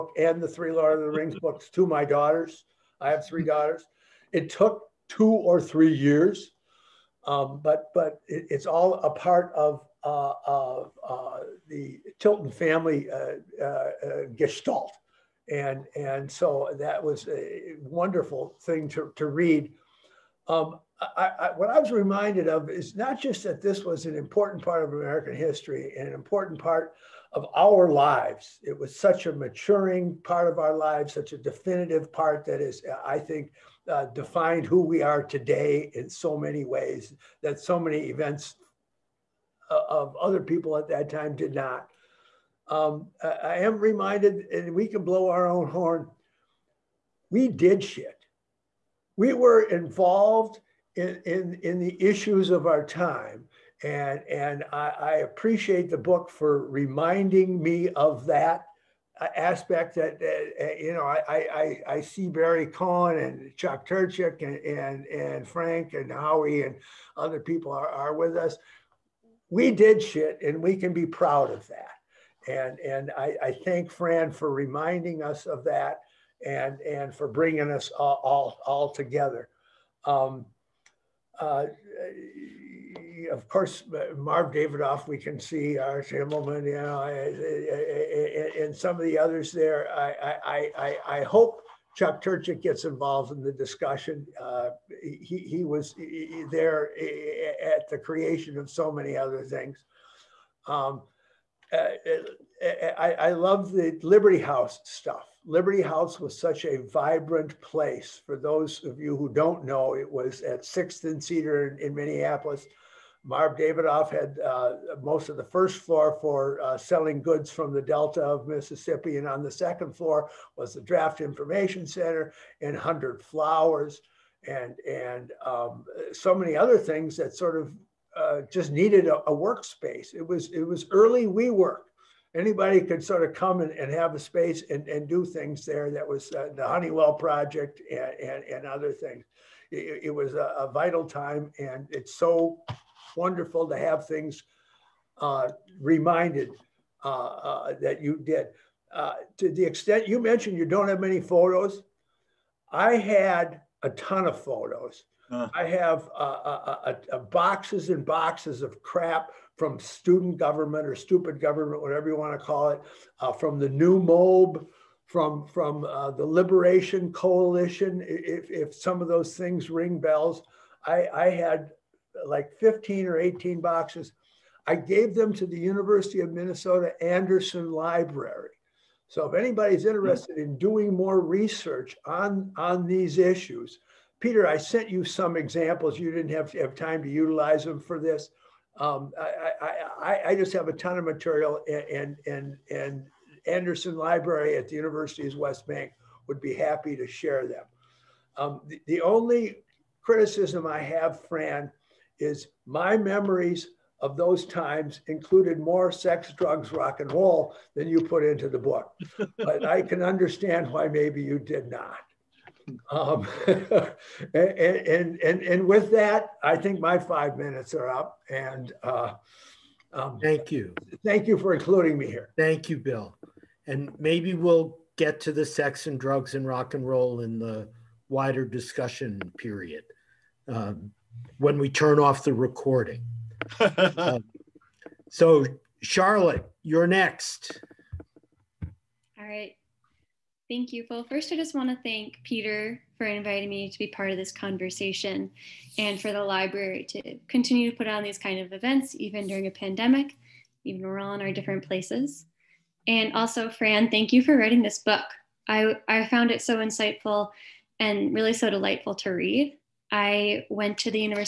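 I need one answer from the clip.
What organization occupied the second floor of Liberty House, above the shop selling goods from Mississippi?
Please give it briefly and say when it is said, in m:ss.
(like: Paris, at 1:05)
Draft Information Center, at 2:00.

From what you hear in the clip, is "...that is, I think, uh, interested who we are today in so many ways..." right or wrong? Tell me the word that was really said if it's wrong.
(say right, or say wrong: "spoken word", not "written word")
wrong: "defined", not "interested".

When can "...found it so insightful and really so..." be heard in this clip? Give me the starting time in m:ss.
4:16.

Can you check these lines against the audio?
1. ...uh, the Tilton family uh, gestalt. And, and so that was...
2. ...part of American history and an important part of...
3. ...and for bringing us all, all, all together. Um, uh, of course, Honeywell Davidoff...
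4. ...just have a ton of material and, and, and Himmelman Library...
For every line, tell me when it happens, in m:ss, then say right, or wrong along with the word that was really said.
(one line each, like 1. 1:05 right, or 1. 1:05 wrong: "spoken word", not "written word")
1. 0:11 right
2. 0:24 right
3. 1:16 wrong: "Marv", not "Honeywell"
4. 3:10 wrong: "Anderson", not "Himmelman".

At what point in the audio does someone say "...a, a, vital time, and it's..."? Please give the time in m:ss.
2:20.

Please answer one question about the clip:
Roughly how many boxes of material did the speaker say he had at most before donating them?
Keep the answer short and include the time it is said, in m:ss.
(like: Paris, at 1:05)
18, at 2:53.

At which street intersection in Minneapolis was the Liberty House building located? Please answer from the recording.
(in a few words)
6th and Cedar.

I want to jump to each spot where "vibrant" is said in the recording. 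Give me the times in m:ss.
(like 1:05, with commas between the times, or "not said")
1:46.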